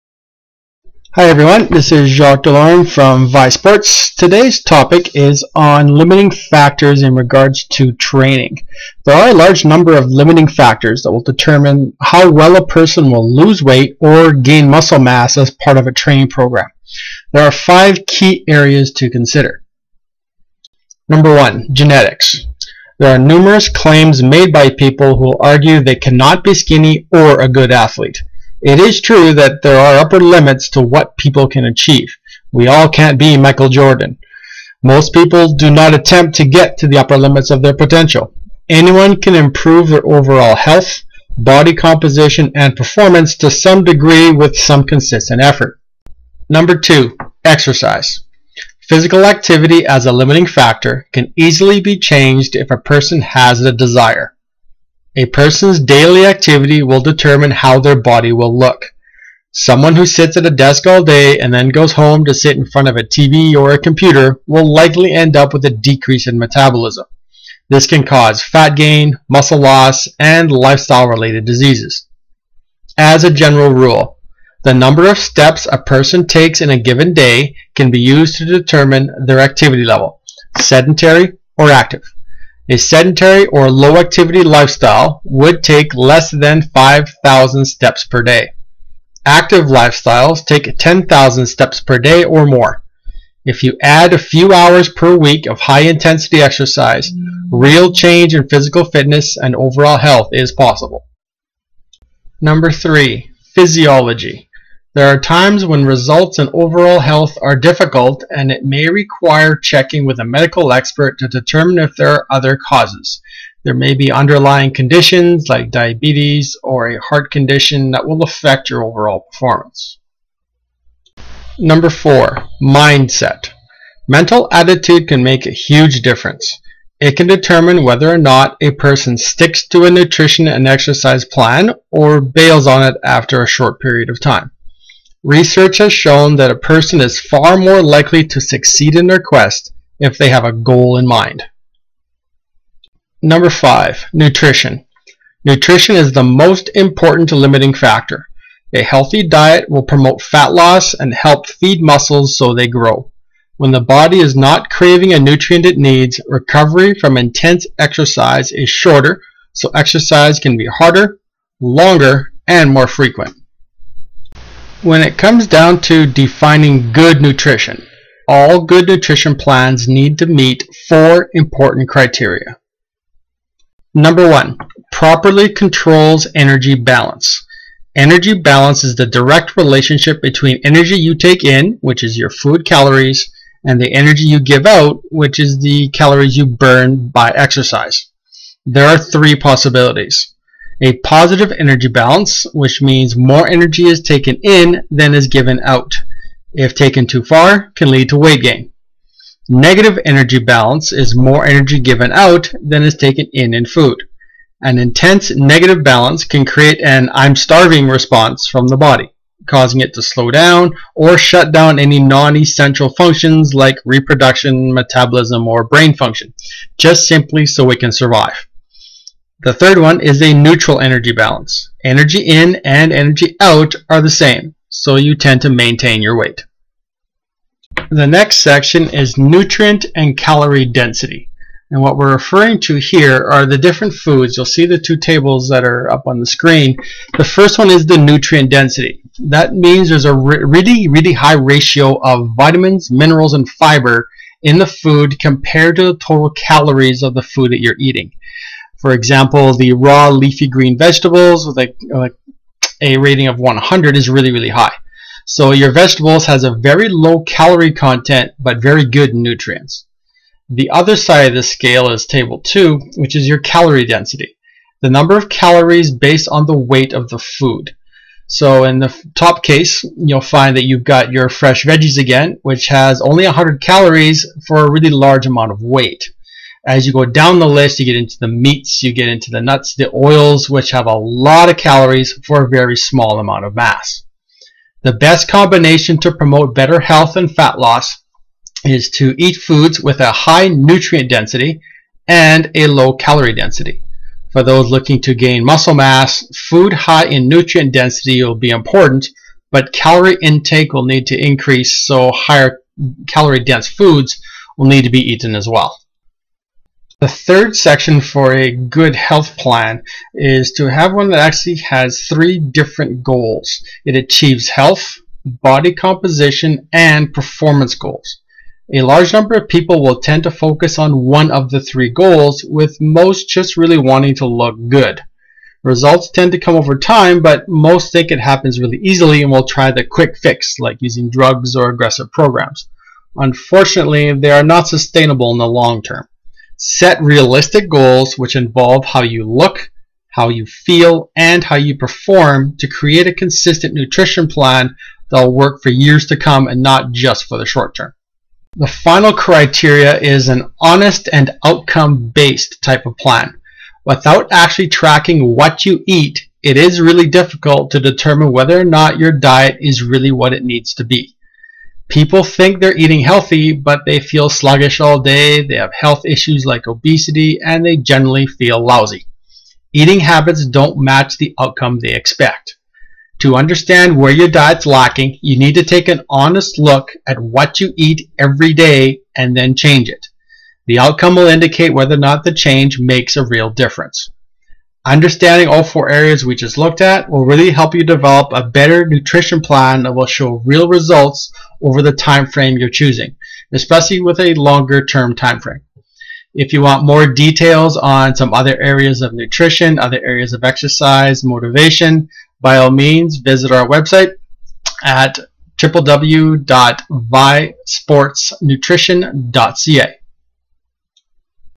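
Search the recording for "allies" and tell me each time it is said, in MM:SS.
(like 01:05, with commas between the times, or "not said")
not said.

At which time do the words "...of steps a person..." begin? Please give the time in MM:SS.
01:15.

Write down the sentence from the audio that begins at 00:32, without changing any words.
We all can't be Michael Jordan.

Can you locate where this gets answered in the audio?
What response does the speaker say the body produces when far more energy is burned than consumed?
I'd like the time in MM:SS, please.
03:27.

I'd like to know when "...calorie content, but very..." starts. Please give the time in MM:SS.
04:17.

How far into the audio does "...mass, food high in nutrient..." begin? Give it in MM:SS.
04:55.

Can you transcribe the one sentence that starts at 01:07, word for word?
This can cause fat gain, muscle loss, and lifestyle-related diseases.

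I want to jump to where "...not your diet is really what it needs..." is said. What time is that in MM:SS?
05:58.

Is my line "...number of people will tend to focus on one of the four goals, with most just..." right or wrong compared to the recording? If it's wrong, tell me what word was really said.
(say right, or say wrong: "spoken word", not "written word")
wrong: "three", not "four".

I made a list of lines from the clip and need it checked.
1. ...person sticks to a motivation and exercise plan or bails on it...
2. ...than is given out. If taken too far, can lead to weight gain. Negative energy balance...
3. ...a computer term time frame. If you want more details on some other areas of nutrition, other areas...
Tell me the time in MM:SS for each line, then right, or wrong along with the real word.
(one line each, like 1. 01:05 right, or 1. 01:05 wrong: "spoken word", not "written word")
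1. 02:08 wrong: "nutrition", not "motivation"
2. 03:14 right
3. 06:34 wrong: "longer", not "computer".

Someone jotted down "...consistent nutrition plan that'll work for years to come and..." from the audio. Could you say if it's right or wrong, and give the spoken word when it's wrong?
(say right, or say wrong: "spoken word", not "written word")
right.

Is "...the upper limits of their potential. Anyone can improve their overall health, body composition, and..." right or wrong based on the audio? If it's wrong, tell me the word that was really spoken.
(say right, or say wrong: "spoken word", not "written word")
right.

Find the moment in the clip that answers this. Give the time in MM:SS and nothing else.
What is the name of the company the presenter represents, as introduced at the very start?
00:03.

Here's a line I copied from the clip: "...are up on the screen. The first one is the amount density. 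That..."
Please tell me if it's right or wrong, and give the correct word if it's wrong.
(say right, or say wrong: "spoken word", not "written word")
wrong: "nutrient", not "amount".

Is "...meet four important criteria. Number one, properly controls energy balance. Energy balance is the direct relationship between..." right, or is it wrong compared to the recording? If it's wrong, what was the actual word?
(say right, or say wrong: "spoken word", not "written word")
right.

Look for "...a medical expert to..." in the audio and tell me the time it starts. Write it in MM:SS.
01:50.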